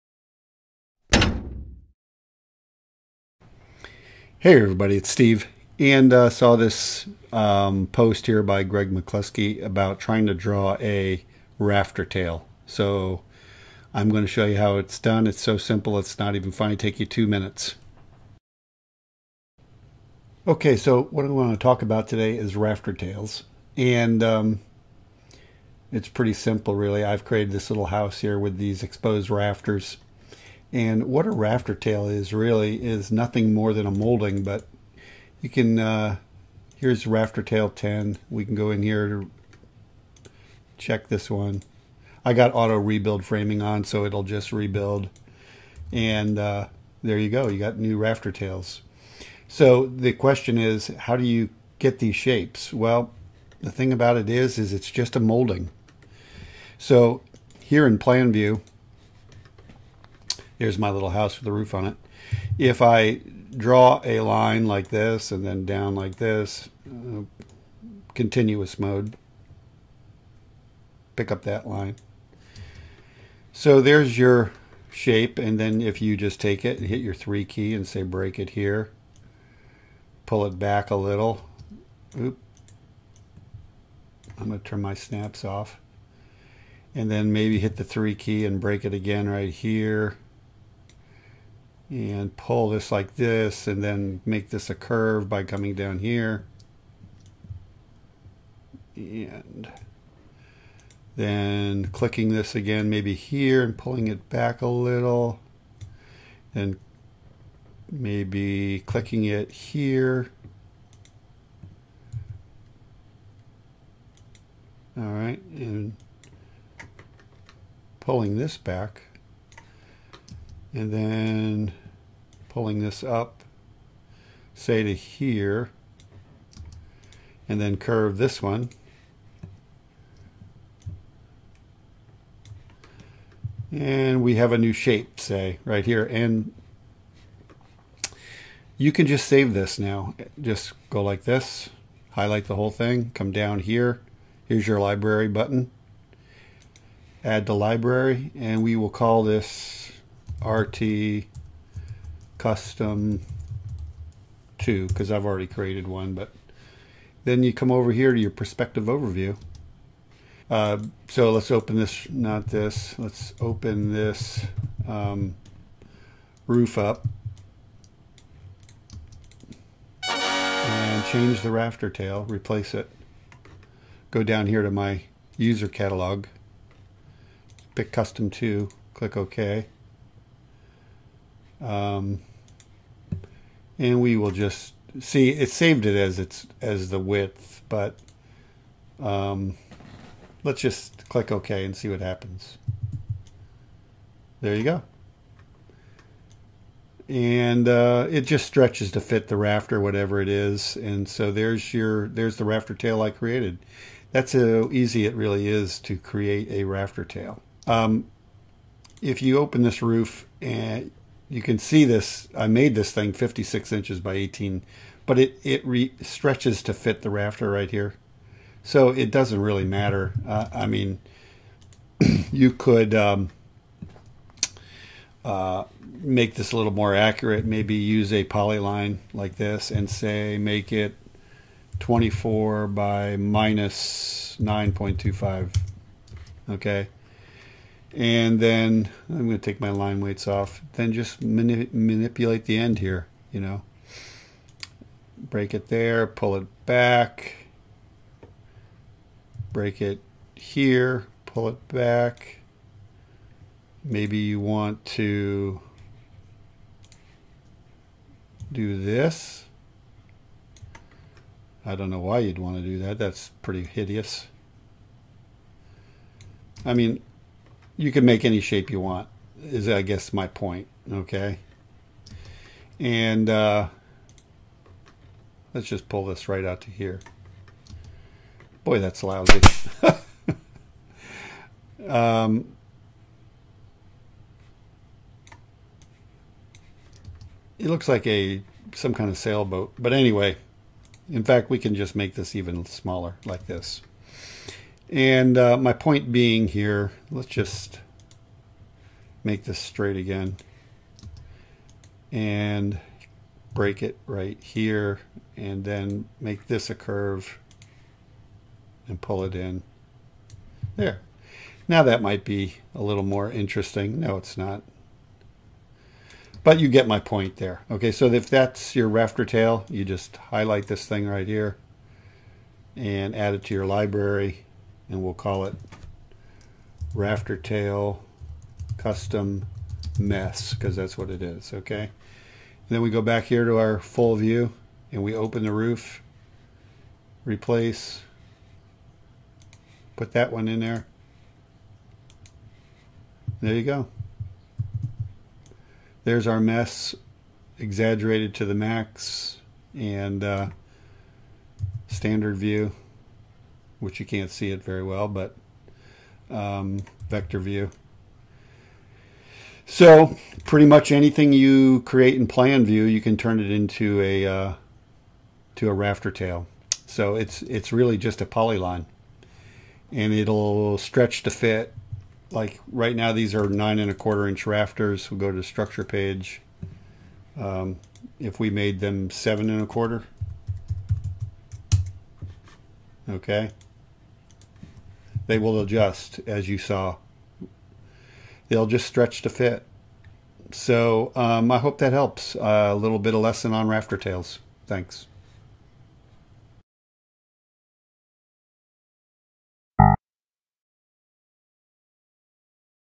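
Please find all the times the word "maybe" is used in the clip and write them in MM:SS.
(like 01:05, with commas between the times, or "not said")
01:27, 01:42, 01:47, 03:47, 04:13.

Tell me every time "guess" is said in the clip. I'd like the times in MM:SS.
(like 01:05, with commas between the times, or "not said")
04:29.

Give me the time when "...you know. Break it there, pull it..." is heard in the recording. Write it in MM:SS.
04:03.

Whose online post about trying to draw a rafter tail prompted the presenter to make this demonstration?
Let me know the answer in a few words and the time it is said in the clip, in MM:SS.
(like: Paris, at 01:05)
Greg McCluskey, at 00:08.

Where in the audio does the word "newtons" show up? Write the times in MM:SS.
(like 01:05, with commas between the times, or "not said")
not said.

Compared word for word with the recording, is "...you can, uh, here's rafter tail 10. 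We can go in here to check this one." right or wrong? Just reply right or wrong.
right.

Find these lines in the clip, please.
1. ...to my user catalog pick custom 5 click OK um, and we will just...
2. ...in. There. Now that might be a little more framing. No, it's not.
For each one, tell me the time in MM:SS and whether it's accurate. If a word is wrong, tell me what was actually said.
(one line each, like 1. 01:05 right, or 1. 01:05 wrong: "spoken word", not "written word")
1. 02:54 wrong: "2", not "5"
2. 05:09 wrong: "interesting", not "framing".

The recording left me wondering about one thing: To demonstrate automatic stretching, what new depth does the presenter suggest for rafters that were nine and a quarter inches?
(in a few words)
7.25 inches.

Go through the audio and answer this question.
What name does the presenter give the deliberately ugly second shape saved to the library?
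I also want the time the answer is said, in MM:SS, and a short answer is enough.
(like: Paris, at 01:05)
rafter tail custom mess, at 05:26.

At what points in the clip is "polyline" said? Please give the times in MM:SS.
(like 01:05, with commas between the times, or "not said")
03:48, 06:08.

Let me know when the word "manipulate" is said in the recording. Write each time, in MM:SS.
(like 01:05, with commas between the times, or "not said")
04:01.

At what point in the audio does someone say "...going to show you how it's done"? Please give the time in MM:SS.
00:14.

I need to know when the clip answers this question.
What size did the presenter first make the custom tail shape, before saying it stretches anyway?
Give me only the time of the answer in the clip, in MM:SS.
03:33.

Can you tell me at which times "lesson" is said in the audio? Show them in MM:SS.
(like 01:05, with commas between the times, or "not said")
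06:33.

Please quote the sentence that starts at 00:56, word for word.
So here in plan view, Here's my little house with a roof on it.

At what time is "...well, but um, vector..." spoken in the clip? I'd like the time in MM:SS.
05:54.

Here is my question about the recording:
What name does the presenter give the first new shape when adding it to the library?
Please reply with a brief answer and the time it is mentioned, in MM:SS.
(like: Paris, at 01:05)
RT custom 2, at 02:30.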